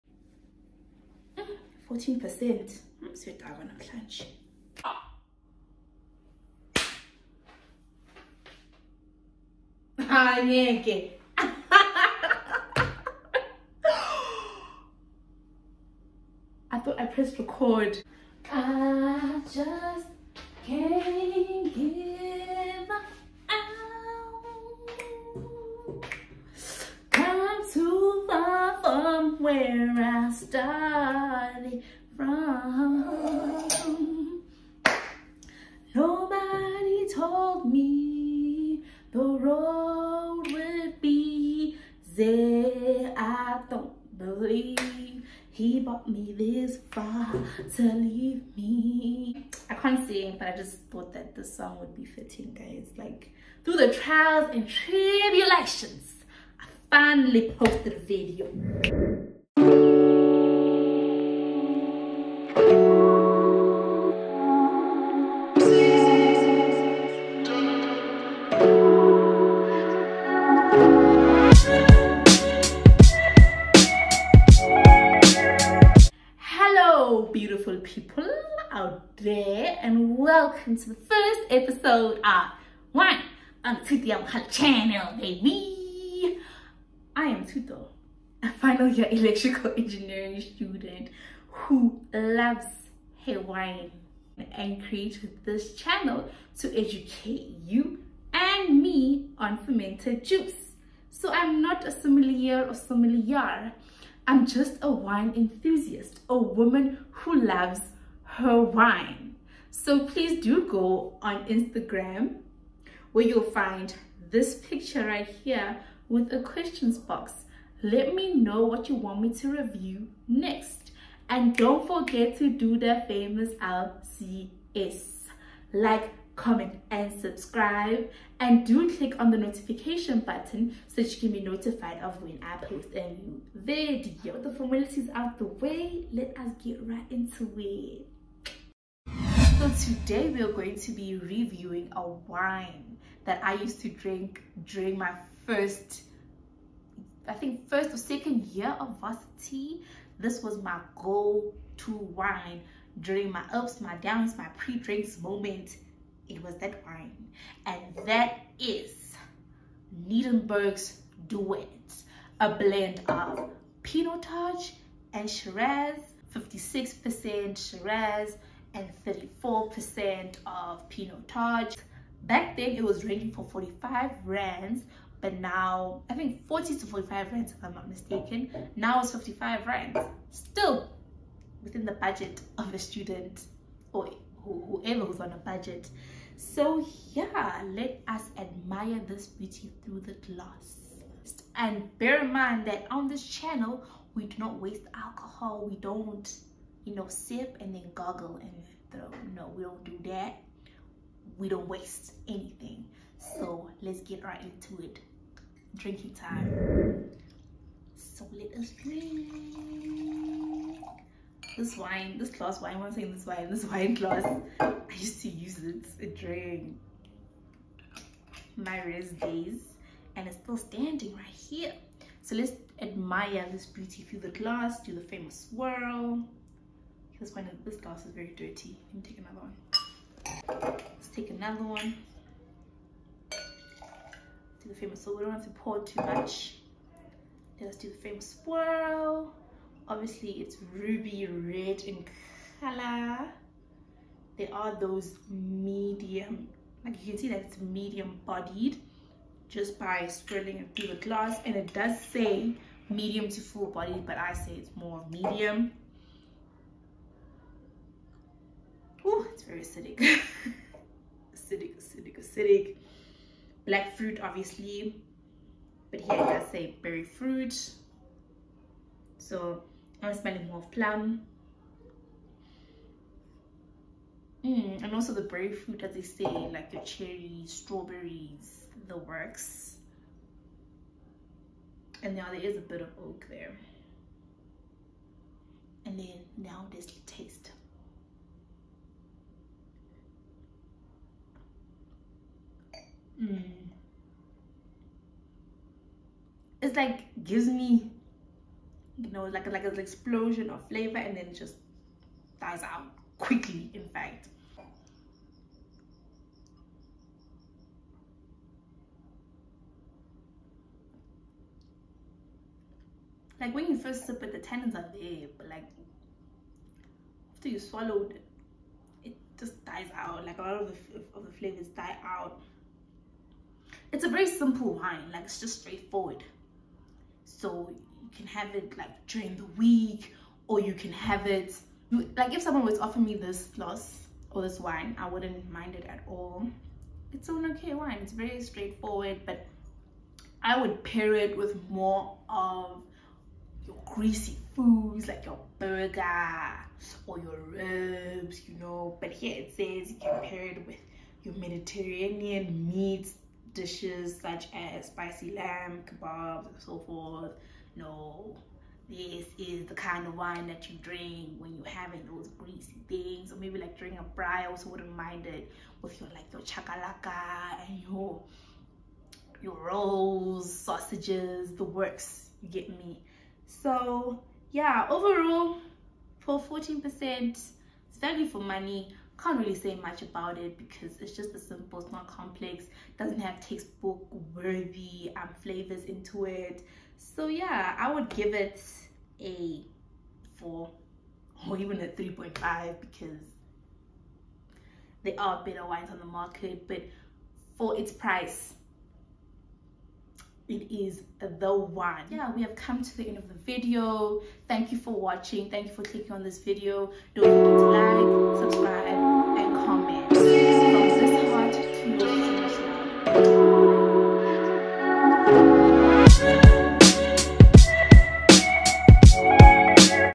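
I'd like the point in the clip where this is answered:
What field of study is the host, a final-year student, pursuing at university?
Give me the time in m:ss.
1:29.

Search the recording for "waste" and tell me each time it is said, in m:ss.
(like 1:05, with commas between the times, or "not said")
3:14, 3:21.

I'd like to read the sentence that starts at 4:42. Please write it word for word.
And now there is a bit of oak there.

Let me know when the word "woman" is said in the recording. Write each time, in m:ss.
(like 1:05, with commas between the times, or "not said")
1:46.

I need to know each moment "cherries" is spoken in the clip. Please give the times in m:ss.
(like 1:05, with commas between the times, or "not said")
4:36.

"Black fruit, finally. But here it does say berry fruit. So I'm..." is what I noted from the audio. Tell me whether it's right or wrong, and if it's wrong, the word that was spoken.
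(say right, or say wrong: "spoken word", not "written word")
wrong: "obviously", not "finally".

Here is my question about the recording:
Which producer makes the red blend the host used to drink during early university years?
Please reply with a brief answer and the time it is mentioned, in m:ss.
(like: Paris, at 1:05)
Nederburg, at 2:40.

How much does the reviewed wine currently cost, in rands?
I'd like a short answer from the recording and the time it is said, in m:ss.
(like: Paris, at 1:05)
55 rands, at 2:59.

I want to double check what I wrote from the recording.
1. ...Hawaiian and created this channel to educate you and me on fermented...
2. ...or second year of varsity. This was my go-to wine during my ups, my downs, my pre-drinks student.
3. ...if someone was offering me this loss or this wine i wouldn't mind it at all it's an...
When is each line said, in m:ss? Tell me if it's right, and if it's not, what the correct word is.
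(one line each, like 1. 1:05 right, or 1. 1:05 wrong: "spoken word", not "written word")
1. 1:33 right
2. 2:27 wrong: "moment", not "student"
3. 5:32 right.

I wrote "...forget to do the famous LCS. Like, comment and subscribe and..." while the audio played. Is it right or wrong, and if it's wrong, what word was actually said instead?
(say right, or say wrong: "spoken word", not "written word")
right.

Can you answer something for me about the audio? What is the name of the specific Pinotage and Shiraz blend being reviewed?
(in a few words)
Duet.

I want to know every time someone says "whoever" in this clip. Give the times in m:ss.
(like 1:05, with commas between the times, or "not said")
3:04.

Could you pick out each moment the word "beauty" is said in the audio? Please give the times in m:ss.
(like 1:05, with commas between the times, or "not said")
3:09, 3:43.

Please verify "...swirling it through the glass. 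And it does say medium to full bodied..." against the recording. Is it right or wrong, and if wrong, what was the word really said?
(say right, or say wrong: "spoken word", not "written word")
right.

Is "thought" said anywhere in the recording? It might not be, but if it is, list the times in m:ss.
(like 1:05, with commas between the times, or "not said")
0:16, 0:50.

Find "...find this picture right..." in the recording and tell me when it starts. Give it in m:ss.
1:53.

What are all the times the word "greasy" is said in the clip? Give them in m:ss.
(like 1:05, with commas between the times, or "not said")
5:43, 6:02.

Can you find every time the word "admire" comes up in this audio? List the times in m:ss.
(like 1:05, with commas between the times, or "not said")
3:08, 3:42.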